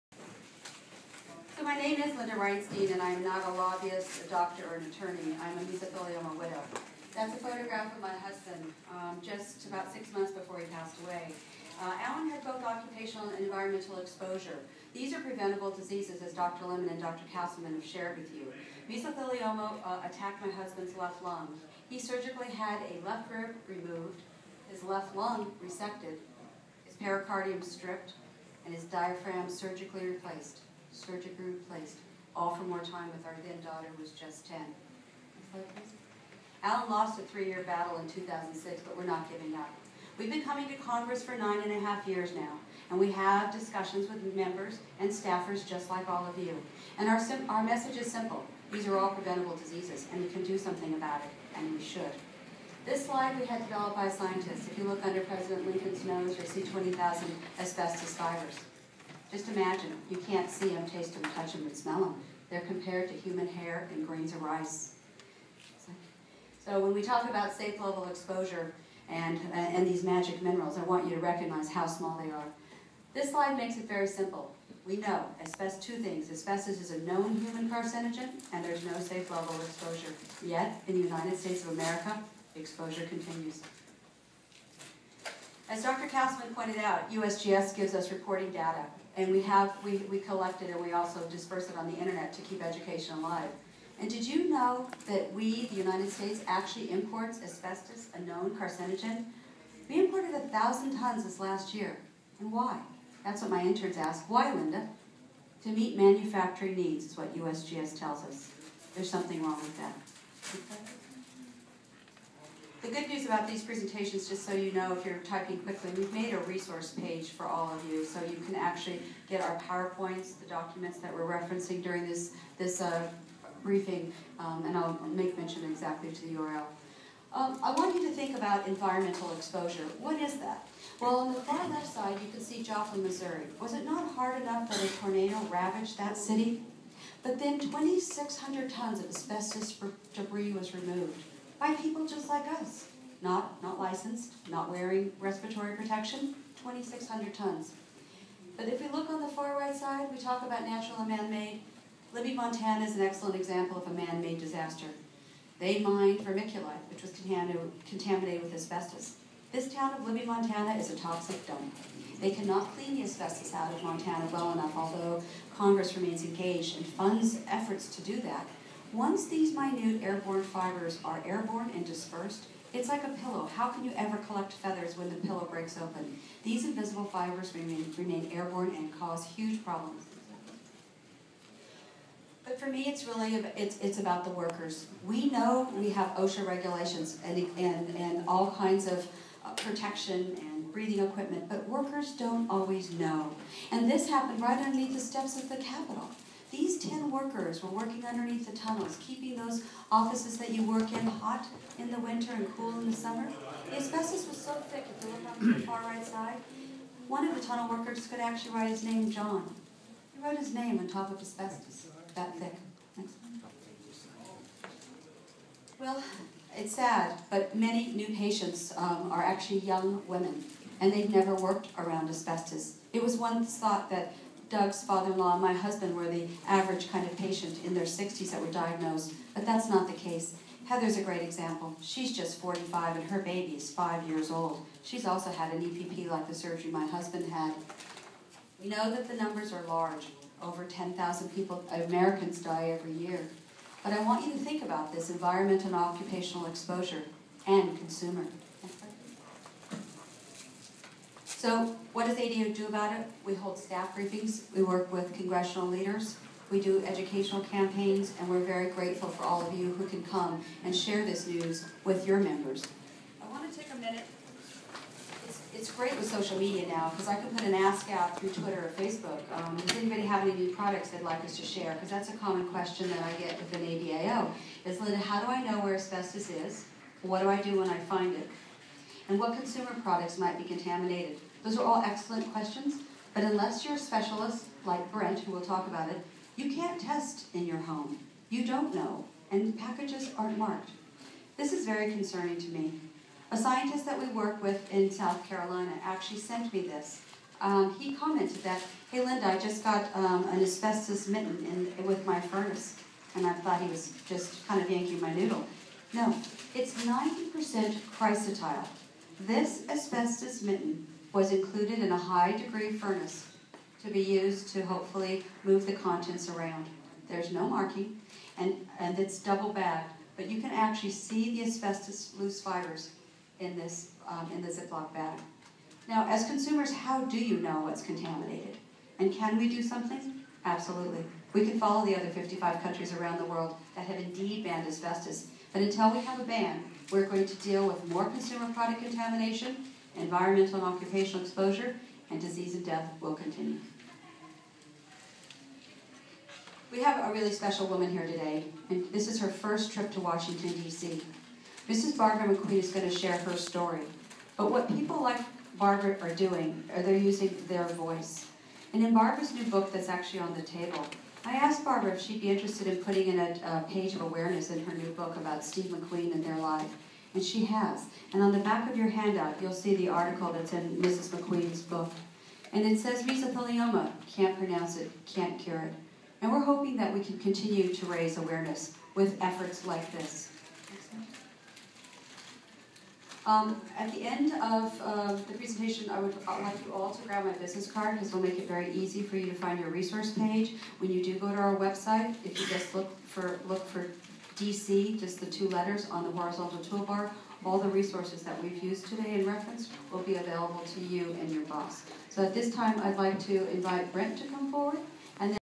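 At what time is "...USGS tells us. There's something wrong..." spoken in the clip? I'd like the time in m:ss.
1:47.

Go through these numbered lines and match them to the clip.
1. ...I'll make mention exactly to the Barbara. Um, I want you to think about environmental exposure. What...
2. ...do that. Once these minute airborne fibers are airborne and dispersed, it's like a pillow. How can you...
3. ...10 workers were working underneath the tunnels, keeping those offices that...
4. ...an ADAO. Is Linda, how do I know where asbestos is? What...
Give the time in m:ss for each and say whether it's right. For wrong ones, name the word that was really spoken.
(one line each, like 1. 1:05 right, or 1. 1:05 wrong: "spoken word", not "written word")
1. 2:04 wrong: "URL", not "Barbara"
2. 2:48 right
3. 3:16 right
4. 4:33 right.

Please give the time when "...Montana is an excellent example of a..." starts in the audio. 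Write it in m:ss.
2:32.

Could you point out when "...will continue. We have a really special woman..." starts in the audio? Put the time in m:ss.
5:43.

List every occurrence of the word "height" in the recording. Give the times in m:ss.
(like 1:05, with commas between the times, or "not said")
not said.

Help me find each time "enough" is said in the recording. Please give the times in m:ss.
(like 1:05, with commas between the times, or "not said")
2:14, 2:44.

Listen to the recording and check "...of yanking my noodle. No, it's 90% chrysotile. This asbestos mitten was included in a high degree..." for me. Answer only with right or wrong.
right.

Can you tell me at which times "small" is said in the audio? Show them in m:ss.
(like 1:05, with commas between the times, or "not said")
1:11.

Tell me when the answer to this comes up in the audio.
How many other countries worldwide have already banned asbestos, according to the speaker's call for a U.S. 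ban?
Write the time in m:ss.
5:32.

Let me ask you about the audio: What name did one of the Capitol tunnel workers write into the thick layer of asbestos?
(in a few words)
John.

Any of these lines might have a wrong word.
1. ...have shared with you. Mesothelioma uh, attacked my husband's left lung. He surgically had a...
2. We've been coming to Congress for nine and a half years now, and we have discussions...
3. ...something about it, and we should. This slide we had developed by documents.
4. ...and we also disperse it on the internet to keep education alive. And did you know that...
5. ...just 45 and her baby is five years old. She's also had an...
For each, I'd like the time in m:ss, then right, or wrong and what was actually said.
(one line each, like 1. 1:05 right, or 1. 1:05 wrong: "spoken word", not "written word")
1. 0:17 right
2. 0:40 right
3. 0:50 wrong: "scientists", not "documents"
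4. 1:30 right
5. 3:52 right.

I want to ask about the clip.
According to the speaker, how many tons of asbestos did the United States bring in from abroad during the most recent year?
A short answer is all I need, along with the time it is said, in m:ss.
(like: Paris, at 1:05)
1,000 tons, at 1:40.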